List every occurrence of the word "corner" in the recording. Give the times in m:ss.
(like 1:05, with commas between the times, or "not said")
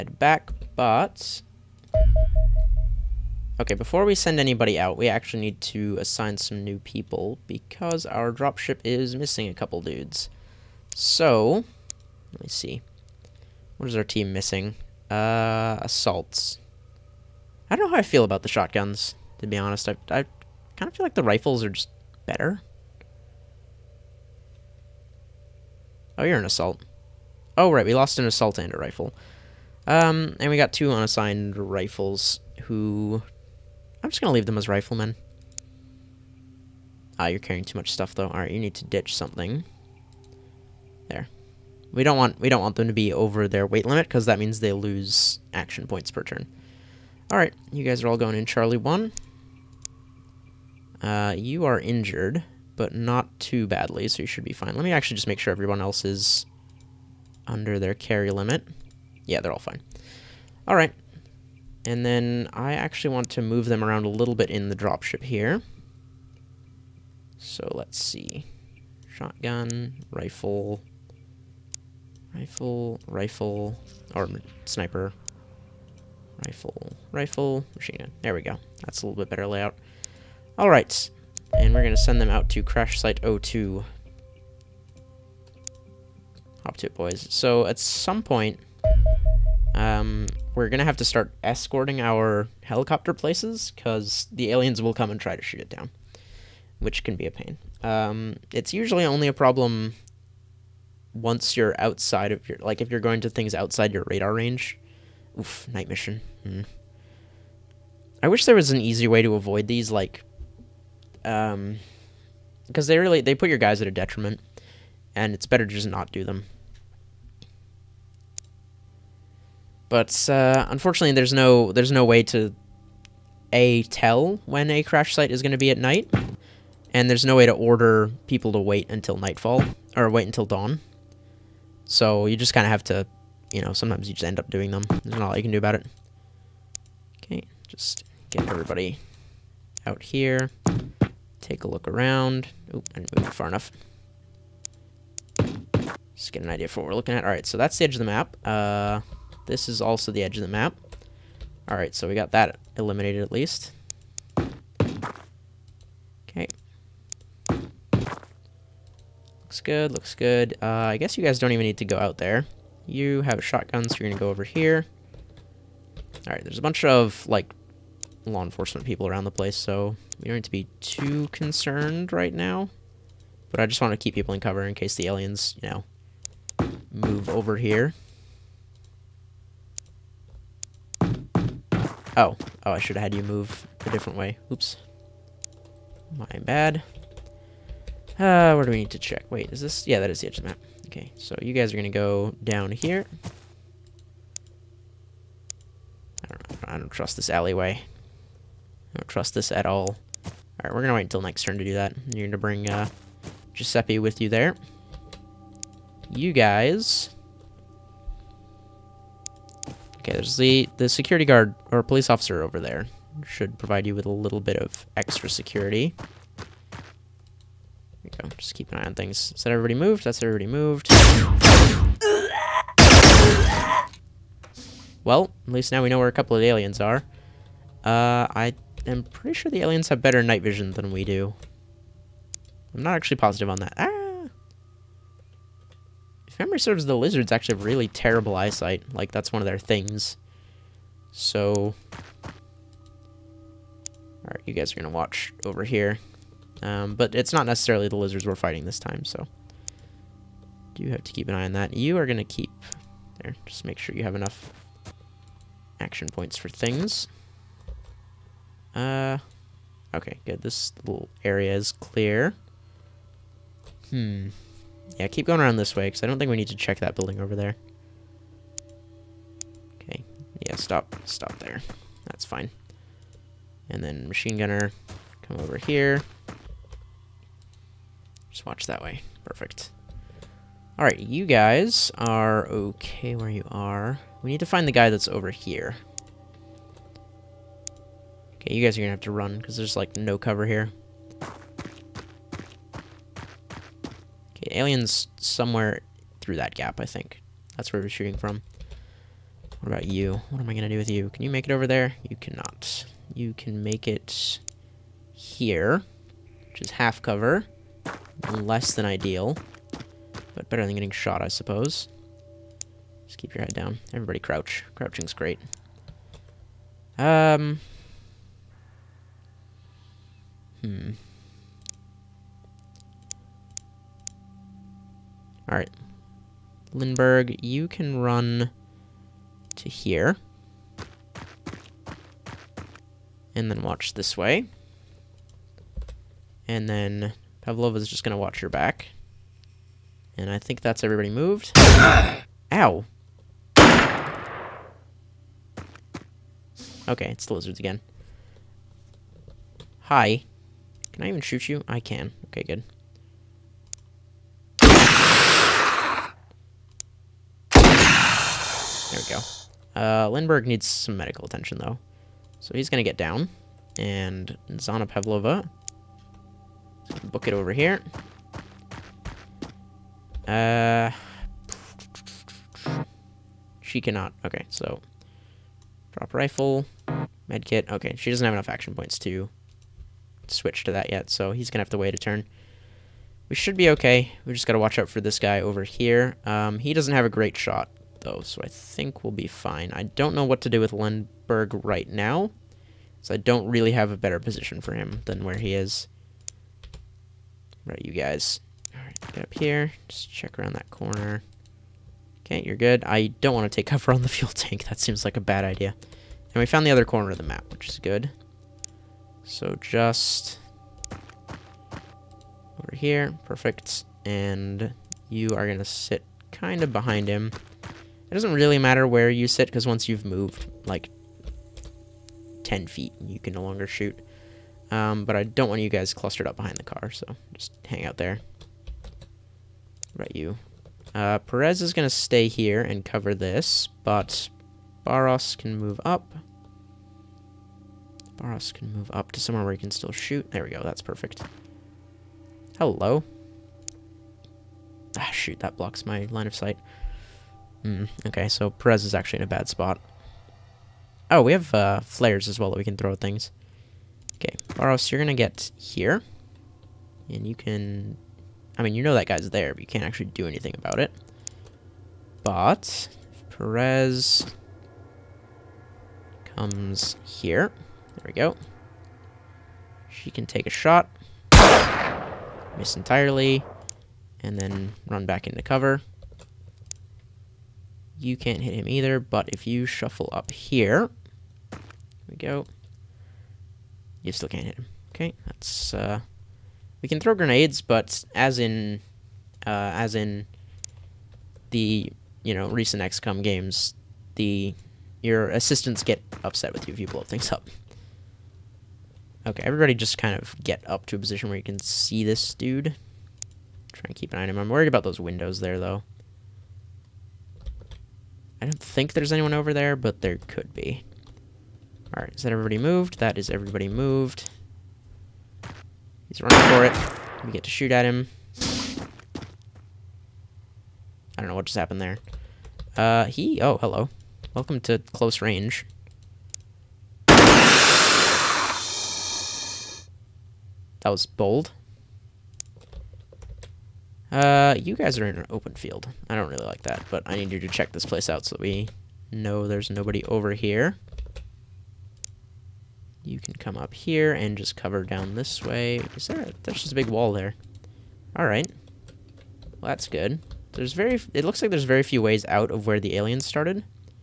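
6:40, 6:46.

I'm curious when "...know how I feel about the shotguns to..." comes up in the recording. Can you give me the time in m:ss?
0:17.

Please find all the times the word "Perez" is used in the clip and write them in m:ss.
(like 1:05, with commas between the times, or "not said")
7:11, 7:28, 7:43.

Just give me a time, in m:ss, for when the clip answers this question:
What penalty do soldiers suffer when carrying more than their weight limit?
0:44.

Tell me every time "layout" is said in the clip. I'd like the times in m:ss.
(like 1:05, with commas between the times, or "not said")
1:19.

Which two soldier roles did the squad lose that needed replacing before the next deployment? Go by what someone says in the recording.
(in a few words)
An assault and a rifle.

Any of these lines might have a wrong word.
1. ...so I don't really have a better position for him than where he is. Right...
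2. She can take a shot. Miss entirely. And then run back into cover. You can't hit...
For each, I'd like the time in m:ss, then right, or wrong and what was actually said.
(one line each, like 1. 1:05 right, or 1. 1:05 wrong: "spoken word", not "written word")
1. 6:33 right
2. 7:49 right.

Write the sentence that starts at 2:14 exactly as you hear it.
There's not a lot you can do about it.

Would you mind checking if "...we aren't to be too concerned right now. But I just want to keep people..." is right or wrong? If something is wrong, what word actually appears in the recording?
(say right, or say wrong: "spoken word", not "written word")
right.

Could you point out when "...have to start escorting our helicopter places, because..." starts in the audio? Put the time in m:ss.
1:30.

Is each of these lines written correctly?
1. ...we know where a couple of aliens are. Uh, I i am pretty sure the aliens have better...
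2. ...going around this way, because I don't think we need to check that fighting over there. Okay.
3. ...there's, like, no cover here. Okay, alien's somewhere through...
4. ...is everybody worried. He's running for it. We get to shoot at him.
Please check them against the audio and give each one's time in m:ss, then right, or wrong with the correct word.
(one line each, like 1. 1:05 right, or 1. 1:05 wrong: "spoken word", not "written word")
1. 3:45 right
2. 4:25 wrong: "building", not "fighting"
3. 4:49 right
4. 8:33 wrong: "moved", not "worried".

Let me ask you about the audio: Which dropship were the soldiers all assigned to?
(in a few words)
Charlie 1.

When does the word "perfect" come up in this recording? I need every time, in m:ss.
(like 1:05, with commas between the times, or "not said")
4:39, 6:53, 7:20.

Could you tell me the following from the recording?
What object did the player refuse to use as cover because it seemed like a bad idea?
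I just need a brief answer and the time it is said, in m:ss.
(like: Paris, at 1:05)
Fuel tank, at 6:44.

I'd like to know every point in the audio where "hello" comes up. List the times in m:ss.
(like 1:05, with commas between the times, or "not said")
7:22, 8:43.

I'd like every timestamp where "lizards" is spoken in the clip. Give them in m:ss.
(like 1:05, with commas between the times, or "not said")
3:56, 4:07, 5:47.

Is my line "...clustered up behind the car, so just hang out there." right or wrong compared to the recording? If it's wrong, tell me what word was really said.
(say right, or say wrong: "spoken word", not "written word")
right.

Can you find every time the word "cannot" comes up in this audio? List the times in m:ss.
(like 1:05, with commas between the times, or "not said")
5:02, 6:13.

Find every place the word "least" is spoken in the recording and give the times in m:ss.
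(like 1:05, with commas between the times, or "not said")
2:33, 3:45.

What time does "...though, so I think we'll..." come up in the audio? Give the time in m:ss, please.
6:27.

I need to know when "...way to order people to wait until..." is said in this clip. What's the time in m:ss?
2:07.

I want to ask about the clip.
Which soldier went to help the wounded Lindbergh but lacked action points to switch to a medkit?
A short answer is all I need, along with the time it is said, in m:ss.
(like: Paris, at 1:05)
Zana Pavlova, at 6:04.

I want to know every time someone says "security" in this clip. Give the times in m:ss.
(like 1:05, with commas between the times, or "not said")
3:30, 3:35.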